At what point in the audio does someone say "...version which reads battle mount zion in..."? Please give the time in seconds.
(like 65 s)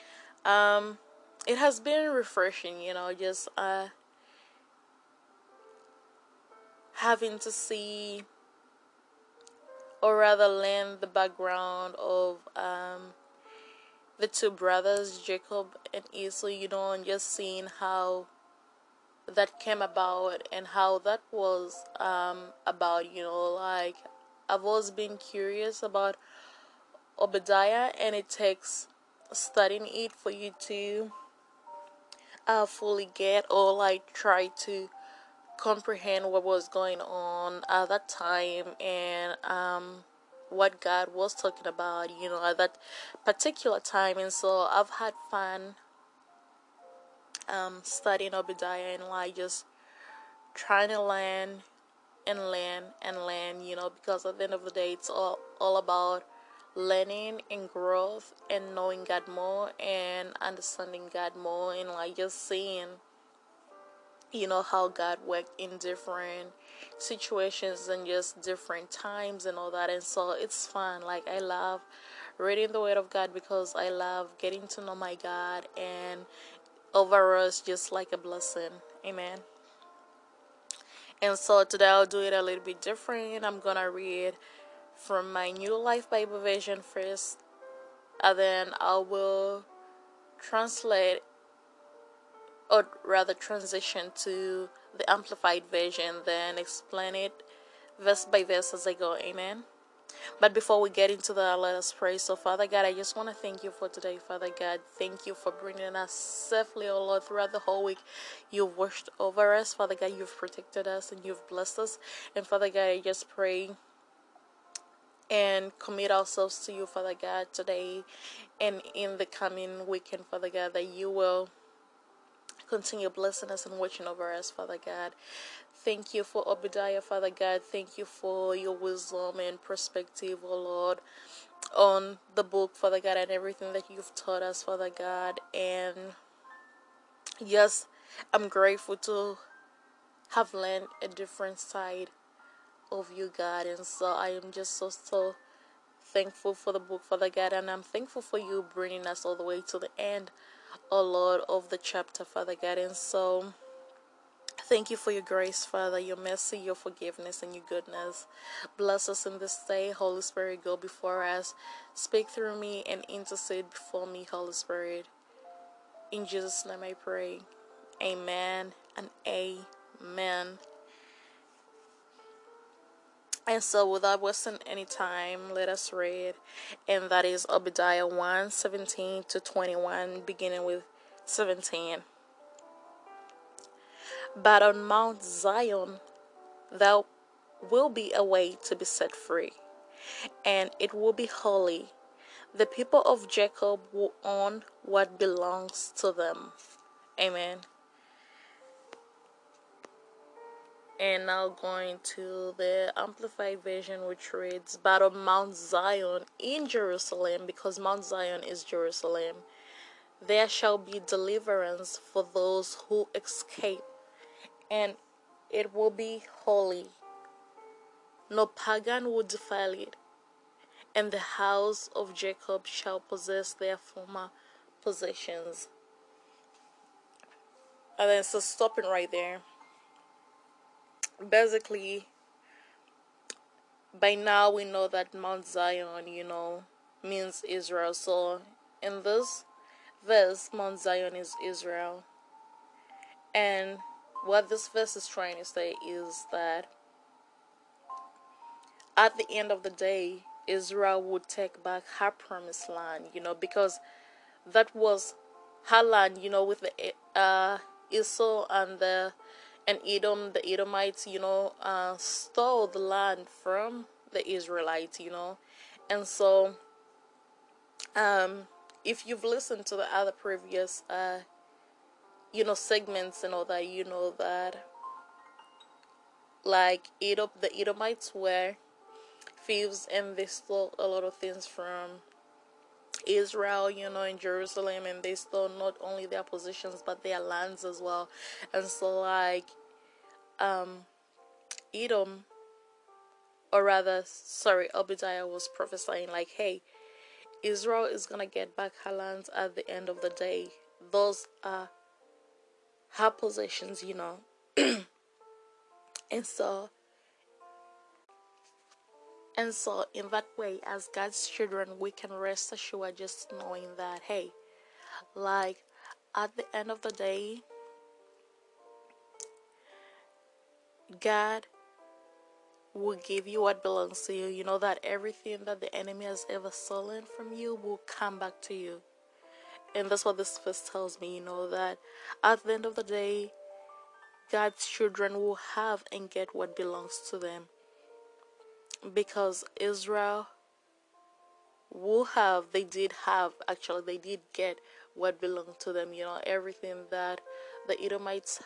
203 s.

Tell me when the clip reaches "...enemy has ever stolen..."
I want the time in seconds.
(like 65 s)
325 s.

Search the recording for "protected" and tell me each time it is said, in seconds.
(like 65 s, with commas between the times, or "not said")
110 s.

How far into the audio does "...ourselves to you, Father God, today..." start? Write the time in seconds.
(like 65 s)
116 s.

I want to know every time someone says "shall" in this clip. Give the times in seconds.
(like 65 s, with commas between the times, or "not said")
210 s, 222 s.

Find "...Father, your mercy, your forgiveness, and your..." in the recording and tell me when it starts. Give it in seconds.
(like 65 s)
155 s.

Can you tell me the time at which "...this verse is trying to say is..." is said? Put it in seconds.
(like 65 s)
244 s.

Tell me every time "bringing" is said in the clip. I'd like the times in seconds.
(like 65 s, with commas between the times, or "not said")
105 s, 148 s.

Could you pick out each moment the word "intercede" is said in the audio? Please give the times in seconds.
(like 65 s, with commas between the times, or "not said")
163 s.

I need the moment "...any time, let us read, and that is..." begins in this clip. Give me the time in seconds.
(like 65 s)
174 s.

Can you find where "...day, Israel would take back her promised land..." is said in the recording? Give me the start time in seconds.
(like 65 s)
249 s.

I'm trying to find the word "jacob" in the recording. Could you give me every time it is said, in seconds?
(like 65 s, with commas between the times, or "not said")
15 s, 193 s, 222 s.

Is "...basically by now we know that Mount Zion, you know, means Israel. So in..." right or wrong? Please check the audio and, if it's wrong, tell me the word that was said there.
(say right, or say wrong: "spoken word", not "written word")
right.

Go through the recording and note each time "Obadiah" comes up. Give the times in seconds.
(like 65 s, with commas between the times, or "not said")
27 s, 48 s, 126 s, 177 s, 294 s.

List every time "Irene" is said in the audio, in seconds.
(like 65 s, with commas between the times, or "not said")
not said.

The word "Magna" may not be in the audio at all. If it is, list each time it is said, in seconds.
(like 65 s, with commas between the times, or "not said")
not said.